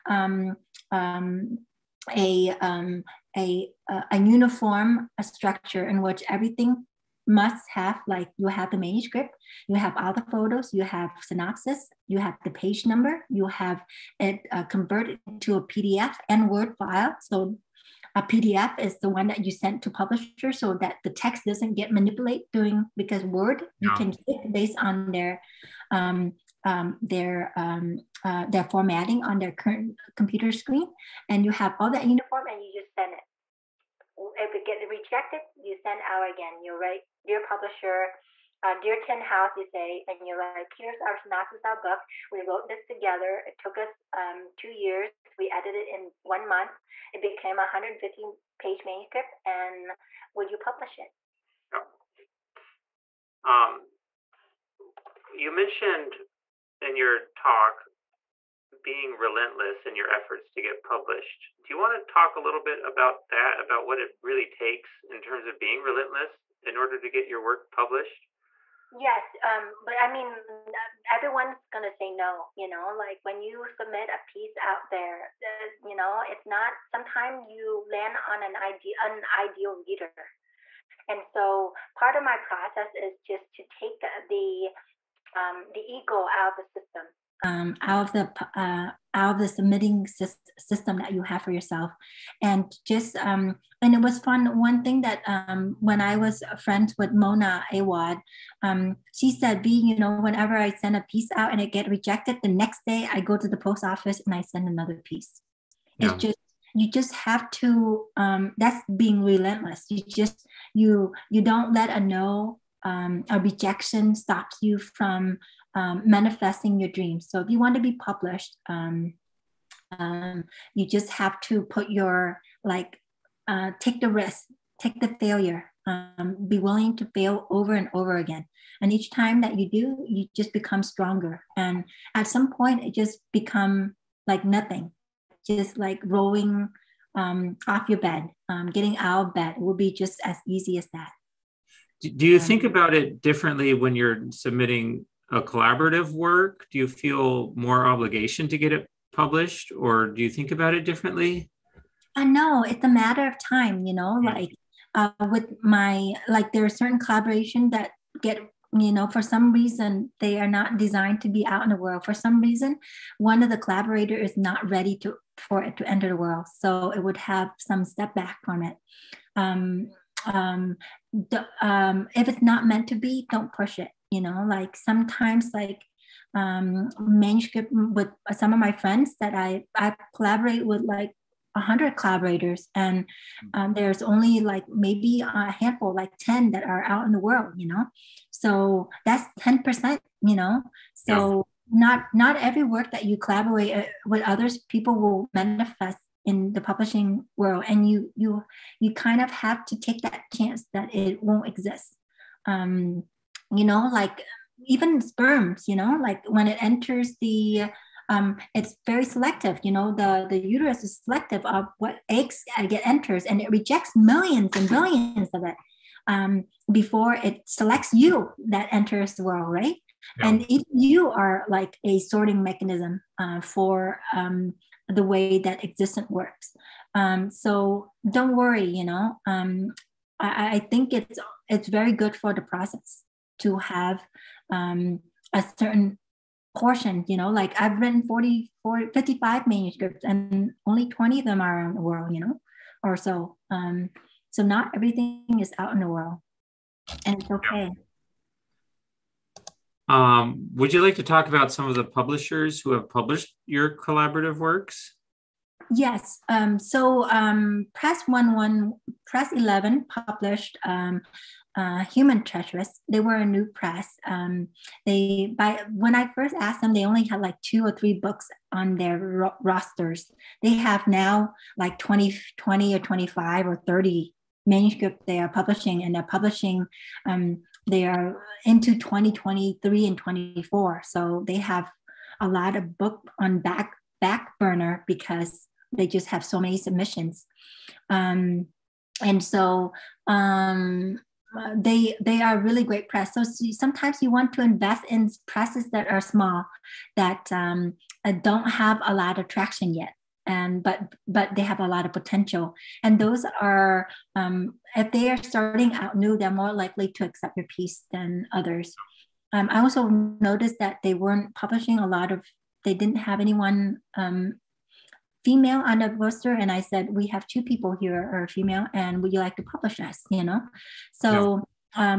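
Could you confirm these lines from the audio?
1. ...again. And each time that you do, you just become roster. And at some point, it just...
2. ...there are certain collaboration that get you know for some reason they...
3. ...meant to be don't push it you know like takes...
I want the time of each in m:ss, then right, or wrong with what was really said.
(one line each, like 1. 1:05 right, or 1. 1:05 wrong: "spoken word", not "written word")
1. 2:08 wrong: "stronger", not "roster"
2. 2:36 right
3. 2:52 wrong: "sometimes", not "takes".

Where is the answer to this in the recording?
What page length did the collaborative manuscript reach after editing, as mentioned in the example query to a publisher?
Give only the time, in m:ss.
0:47.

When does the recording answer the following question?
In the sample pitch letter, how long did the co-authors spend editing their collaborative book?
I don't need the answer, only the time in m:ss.
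0:46.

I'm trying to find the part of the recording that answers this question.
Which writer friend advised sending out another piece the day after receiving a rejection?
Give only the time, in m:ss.
1:37.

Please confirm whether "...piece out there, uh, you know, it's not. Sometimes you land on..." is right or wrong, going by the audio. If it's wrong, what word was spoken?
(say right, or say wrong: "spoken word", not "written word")
right.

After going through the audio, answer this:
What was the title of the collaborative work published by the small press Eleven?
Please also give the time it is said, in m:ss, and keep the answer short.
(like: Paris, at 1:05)
Human Treasures, at 4:21.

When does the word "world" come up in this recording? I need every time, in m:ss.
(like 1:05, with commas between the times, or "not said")
2:41, 2:46, 3:07, 3:17, 3:39, 4:01, 4:05.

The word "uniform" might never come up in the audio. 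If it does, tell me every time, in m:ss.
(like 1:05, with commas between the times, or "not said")
0:04, 0:32.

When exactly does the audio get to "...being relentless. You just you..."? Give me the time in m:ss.
1:48.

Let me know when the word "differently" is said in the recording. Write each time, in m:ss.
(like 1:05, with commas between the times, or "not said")
2:23, 2:30.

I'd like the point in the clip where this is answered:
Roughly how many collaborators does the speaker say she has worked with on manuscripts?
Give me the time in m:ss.
3:01.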